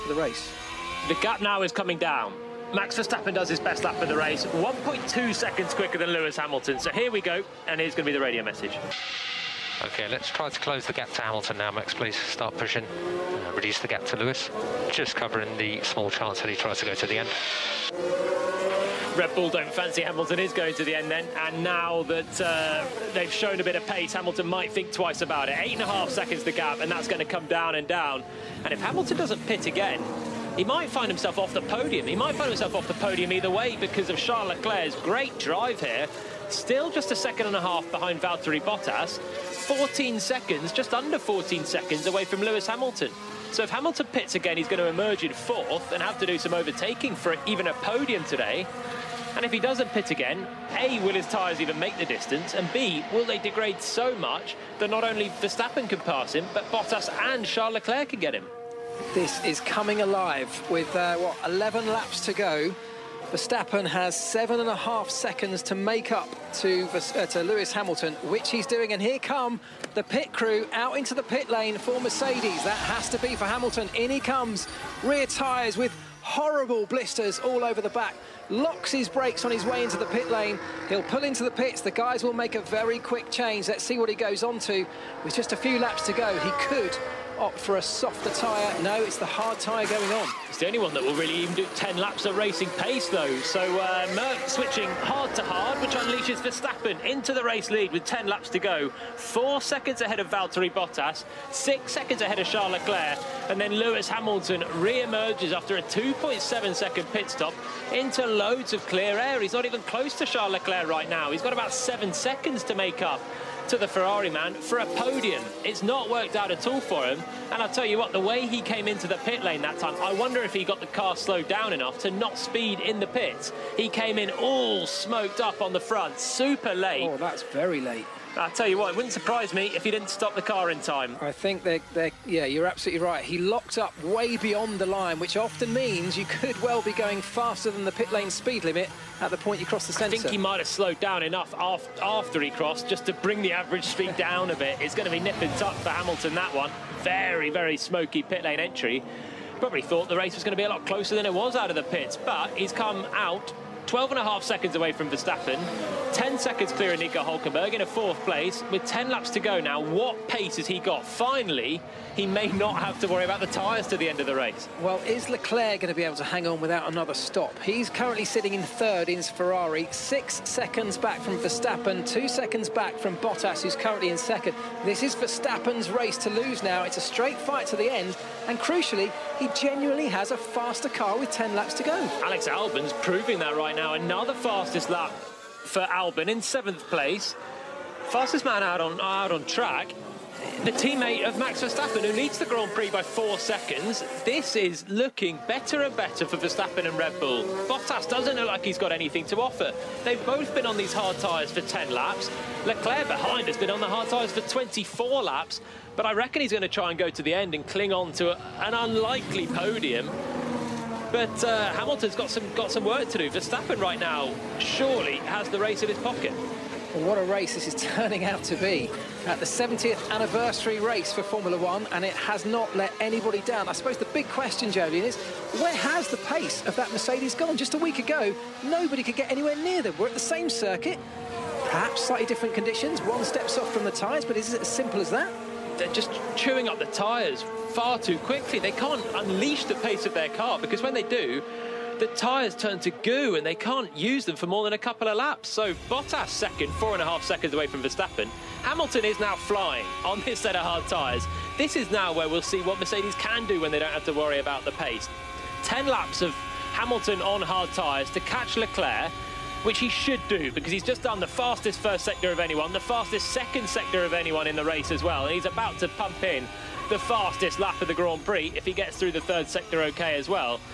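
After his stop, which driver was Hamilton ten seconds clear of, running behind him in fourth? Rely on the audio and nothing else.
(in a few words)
Nico Hulkenberg.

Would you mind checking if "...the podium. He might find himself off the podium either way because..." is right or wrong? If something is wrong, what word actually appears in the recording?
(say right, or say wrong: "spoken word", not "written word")
right.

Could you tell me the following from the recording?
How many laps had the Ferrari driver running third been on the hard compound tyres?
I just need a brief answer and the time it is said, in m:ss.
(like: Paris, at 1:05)
24, at 3:24.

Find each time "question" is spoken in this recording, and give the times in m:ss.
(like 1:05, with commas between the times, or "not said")
3:44.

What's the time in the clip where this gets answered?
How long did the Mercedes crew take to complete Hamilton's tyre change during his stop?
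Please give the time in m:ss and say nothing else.
1:45.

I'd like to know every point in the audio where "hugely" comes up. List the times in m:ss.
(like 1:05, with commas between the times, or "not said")
not said.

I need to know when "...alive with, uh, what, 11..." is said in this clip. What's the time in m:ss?
1:00.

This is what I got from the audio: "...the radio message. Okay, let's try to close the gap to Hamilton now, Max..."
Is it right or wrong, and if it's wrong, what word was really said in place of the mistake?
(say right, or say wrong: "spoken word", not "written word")
right.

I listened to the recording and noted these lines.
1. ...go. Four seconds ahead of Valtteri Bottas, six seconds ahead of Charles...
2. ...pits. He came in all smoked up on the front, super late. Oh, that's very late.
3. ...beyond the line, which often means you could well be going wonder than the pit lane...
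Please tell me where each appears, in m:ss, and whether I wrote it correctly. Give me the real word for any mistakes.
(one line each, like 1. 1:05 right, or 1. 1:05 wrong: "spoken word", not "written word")
1. 1:38 right
2. 2:03 right
3. 2:14 wrong: "faster", not "wonder".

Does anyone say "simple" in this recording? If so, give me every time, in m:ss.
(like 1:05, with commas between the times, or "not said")
3:54.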